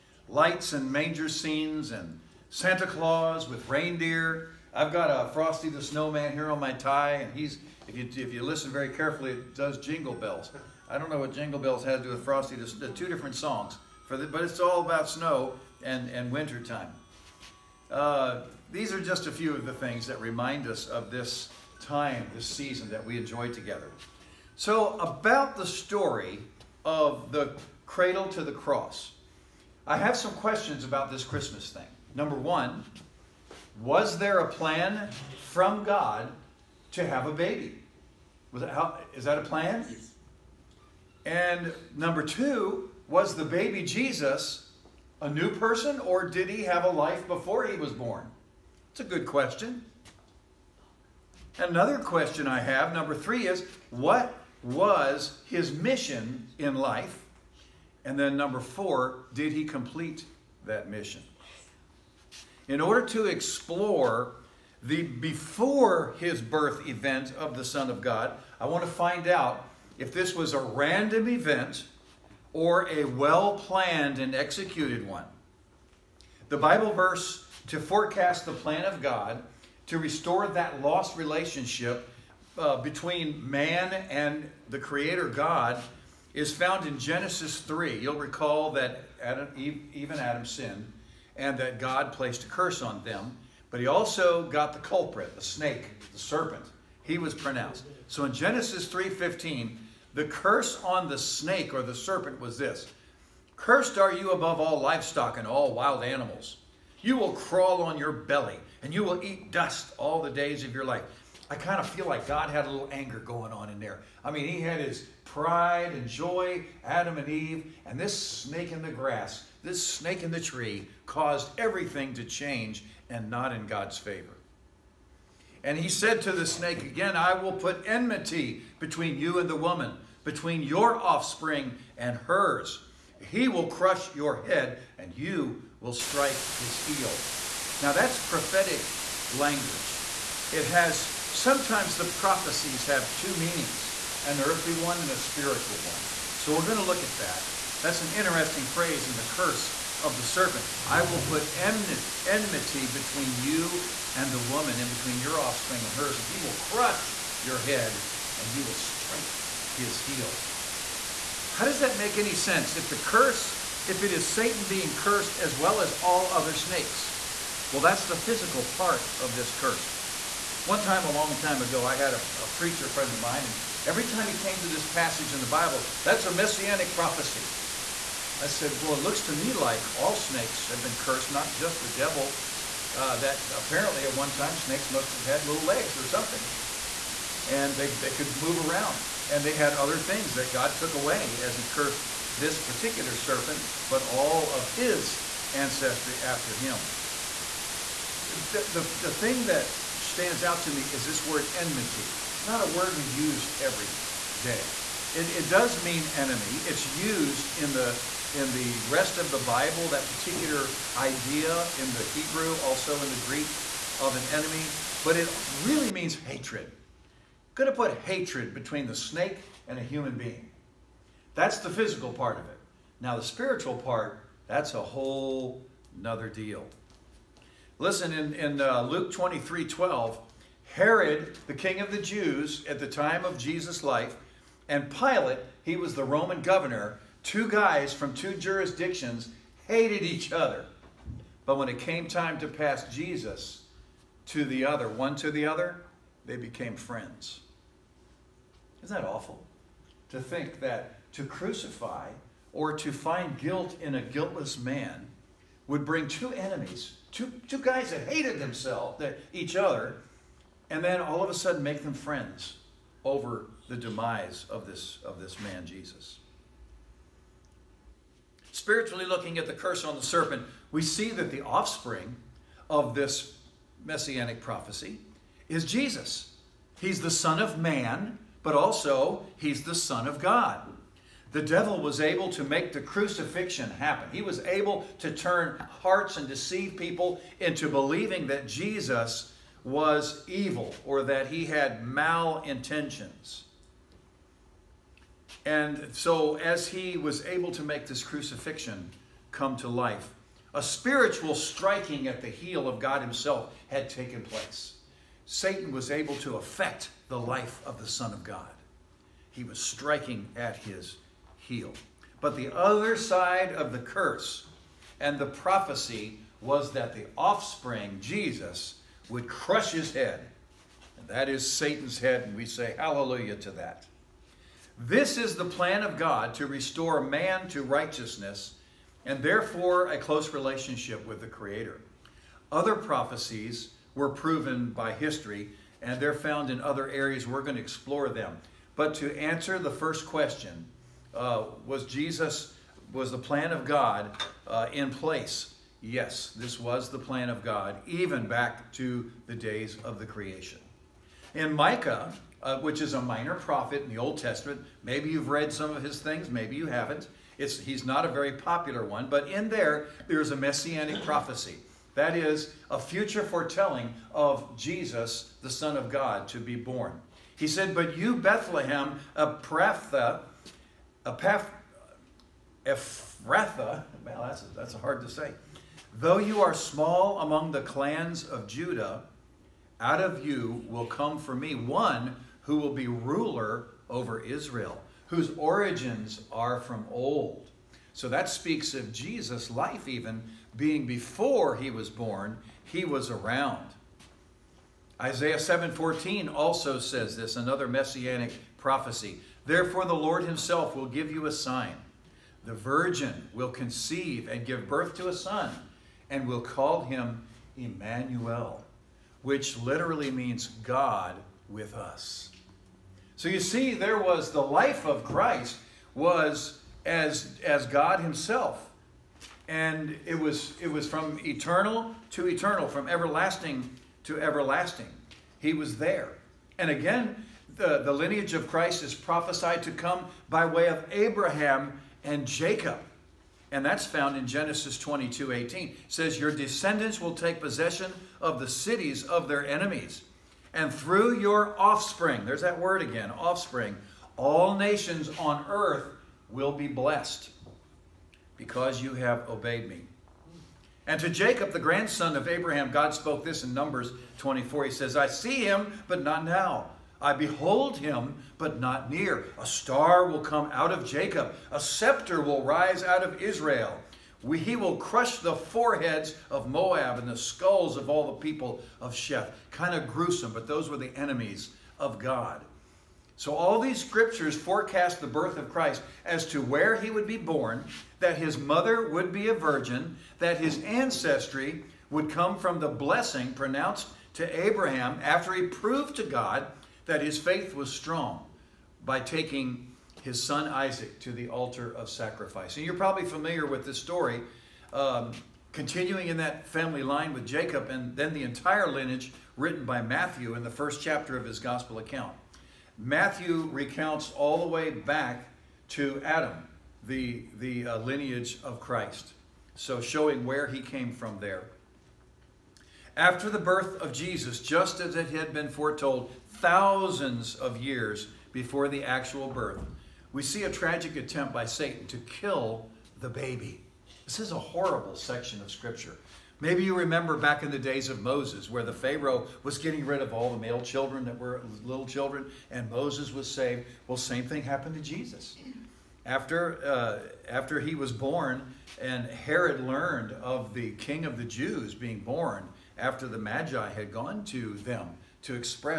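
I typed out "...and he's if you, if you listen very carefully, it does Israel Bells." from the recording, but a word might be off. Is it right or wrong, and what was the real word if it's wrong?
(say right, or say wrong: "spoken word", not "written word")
wrong: "Jingle", not "Israel".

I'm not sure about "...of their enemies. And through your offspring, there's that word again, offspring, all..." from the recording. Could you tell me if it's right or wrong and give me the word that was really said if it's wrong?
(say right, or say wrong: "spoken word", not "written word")
right.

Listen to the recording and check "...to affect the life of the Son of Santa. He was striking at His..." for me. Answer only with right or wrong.
wrong.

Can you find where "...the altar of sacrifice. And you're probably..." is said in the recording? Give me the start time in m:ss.
8:11.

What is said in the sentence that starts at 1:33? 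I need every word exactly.
But he also got the culprit, the snake, the serpent.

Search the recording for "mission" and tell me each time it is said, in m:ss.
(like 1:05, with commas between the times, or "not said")
0:55, 1:00.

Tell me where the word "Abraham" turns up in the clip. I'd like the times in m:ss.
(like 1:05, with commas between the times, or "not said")
7:10, 7:32, 8:04.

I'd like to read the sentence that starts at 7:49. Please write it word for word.
Kind of gruesome, but those were the enemies of God.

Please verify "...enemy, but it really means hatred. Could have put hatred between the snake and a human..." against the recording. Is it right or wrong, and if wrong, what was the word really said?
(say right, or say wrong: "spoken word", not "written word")
right.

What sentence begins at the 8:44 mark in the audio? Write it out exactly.
This is a horrible section of Scripture.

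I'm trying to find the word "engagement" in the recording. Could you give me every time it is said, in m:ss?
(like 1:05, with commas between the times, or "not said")
not said.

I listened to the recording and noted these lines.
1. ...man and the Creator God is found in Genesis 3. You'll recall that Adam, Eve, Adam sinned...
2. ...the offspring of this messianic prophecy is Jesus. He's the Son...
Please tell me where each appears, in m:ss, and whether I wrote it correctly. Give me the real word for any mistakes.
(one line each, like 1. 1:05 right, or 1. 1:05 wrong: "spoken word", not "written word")
1. 1:23 right
2. 4:31 right.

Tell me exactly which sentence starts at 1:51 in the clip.
I kind of feel like God had a little anger going on in there.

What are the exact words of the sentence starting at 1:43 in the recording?
Cursed are you above all livestock and all wild animals.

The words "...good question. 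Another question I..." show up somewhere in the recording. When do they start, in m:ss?
0:49.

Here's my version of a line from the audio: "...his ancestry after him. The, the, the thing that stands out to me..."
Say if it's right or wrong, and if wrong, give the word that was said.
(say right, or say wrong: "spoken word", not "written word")
right.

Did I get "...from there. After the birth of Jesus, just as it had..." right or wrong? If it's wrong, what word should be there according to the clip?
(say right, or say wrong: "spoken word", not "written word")
right.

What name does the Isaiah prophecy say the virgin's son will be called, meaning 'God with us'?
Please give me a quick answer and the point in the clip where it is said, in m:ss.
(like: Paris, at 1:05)
Emmanuel, at 6:47.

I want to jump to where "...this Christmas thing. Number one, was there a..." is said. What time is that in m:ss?
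0:31.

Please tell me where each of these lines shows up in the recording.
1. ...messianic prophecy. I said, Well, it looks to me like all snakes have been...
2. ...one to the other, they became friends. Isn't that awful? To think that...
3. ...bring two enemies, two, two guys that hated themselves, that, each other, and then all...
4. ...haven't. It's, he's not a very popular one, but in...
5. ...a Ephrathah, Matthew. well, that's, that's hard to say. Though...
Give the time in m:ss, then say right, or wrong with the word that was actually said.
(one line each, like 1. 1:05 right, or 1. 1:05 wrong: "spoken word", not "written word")
1. 2:56 right
2. 4:04 right
3. 4:15 right
4. 5:56 right
5. 6:09 wrong: "Ephratha", not "Matthew".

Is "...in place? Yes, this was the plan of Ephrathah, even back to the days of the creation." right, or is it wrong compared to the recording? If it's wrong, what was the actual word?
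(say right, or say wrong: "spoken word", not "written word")
wrong: "God", not "Ephrathah".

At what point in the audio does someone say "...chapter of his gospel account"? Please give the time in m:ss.
8:20.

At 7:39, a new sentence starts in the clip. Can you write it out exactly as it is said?
A star will come out of Jacob, a scepter will rise out of Israel.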